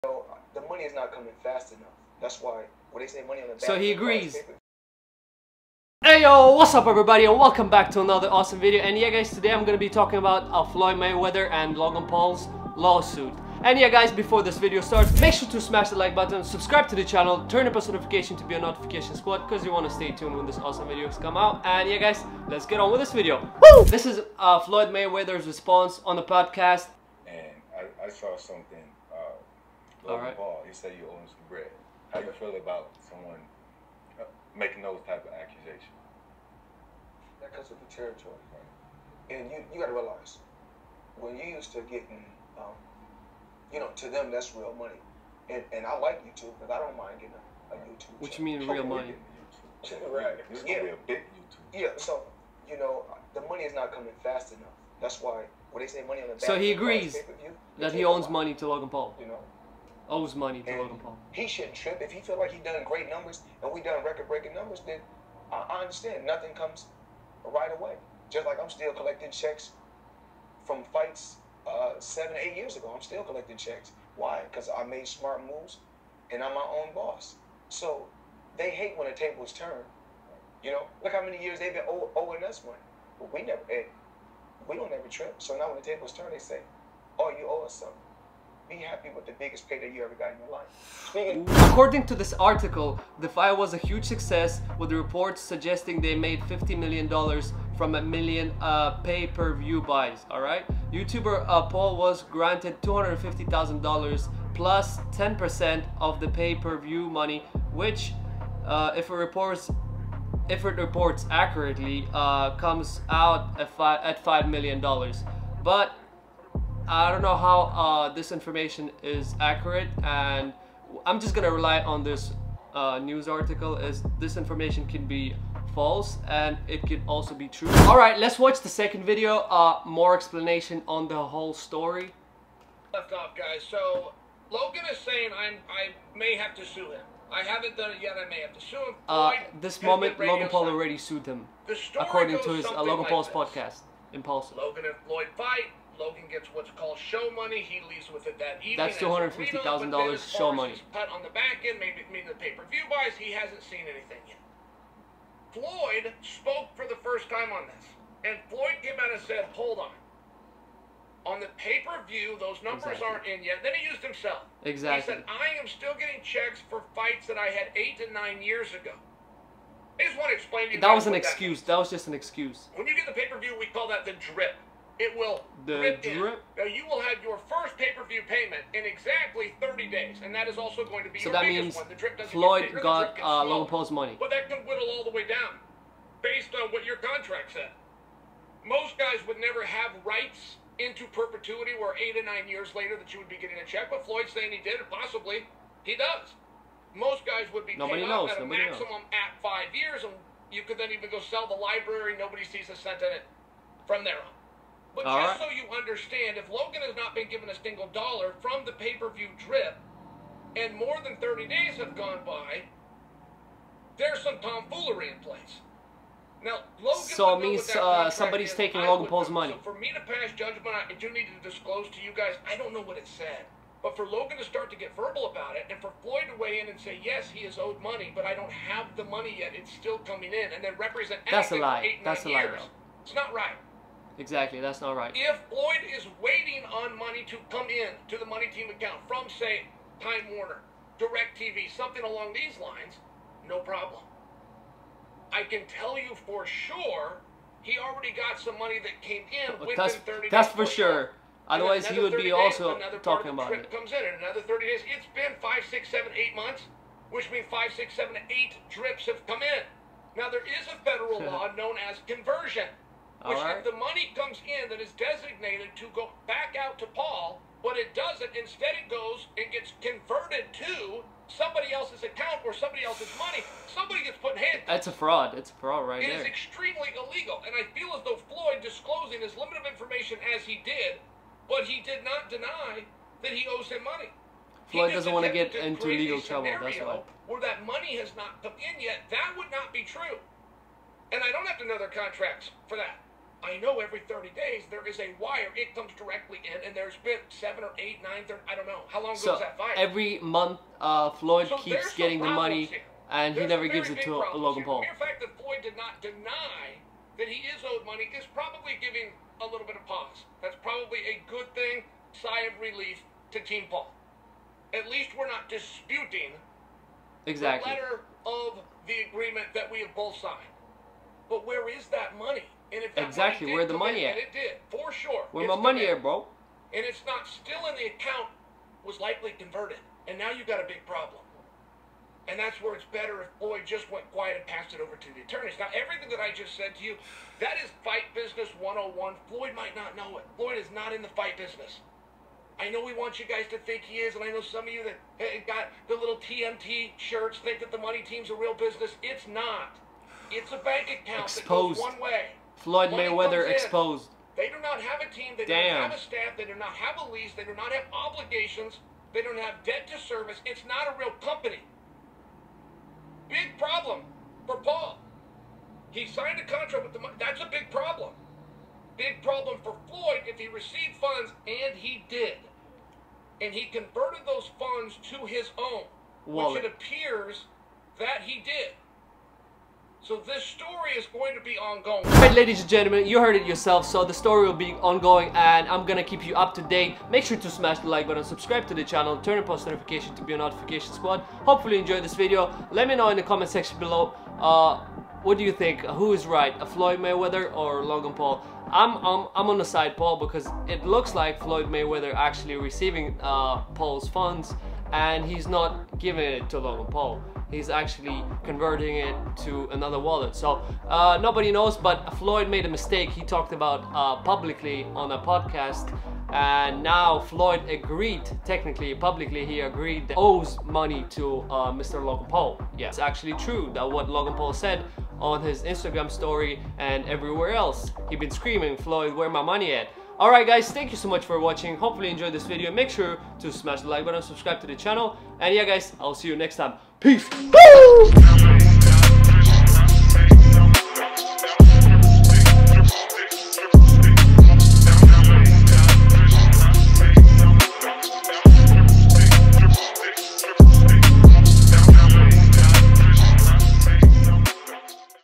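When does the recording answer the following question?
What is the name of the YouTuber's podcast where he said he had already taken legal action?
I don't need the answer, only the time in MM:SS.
02:24.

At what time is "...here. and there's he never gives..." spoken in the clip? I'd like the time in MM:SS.
05:02.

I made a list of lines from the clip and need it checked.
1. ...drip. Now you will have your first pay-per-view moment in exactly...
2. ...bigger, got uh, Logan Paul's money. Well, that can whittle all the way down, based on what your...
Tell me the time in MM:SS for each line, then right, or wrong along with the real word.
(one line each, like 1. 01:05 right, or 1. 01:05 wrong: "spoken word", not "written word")
1. 02:56 wrong: "payment", not "moment"
2. 03:02 right.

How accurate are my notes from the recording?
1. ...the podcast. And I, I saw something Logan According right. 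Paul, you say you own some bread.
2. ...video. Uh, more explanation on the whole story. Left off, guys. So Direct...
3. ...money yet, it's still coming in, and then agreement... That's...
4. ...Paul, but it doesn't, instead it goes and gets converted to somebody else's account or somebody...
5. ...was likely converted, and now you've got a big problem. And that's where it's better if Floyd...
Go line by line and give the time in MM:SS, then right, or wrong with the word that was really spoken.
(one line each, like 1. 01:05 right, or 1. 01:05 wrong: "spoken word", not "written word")
1. 00:26 wrong: "All", not "According"
2. 02:09 wrong: "Logan", not "Direct"
3. 03:49 wrong: "represent", not "agreement"
4. 04:26 right
5. 05:28 right.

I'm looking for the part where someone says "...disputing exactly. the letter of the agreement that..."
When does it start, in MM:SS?
05:15.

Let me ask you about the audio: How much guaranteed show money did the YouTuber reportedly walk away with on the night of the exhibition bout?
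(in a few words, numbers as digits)
$250,000.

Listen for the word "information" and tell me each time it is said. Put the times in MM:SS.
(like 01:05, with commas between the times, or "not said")
01:58, 02:04, 04:39.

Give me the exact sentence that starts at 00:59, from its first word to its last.
You know, owes money to and Logan Paul.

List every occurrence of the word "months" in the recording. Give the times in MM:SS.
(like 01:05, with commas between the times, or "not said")
04:16, 05:00.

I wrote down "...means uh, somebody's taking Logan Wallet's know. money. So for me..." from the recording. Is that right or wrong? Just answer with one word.
wrong.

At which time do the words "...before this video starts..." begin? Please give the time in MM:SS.
00:14.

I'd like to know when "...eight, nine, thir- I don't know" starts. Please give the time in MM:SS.
04:57.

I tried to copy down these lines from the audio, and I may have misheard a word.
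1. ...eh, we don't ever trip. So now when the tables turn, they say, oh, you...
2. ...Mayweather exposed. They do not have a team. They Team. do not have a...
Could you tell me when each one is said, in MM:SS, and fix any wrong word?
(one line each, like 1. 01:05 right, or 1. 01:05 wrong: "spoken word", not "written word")
1. 01:23 right
2. 05:52 wrong: "Damn", not "Team".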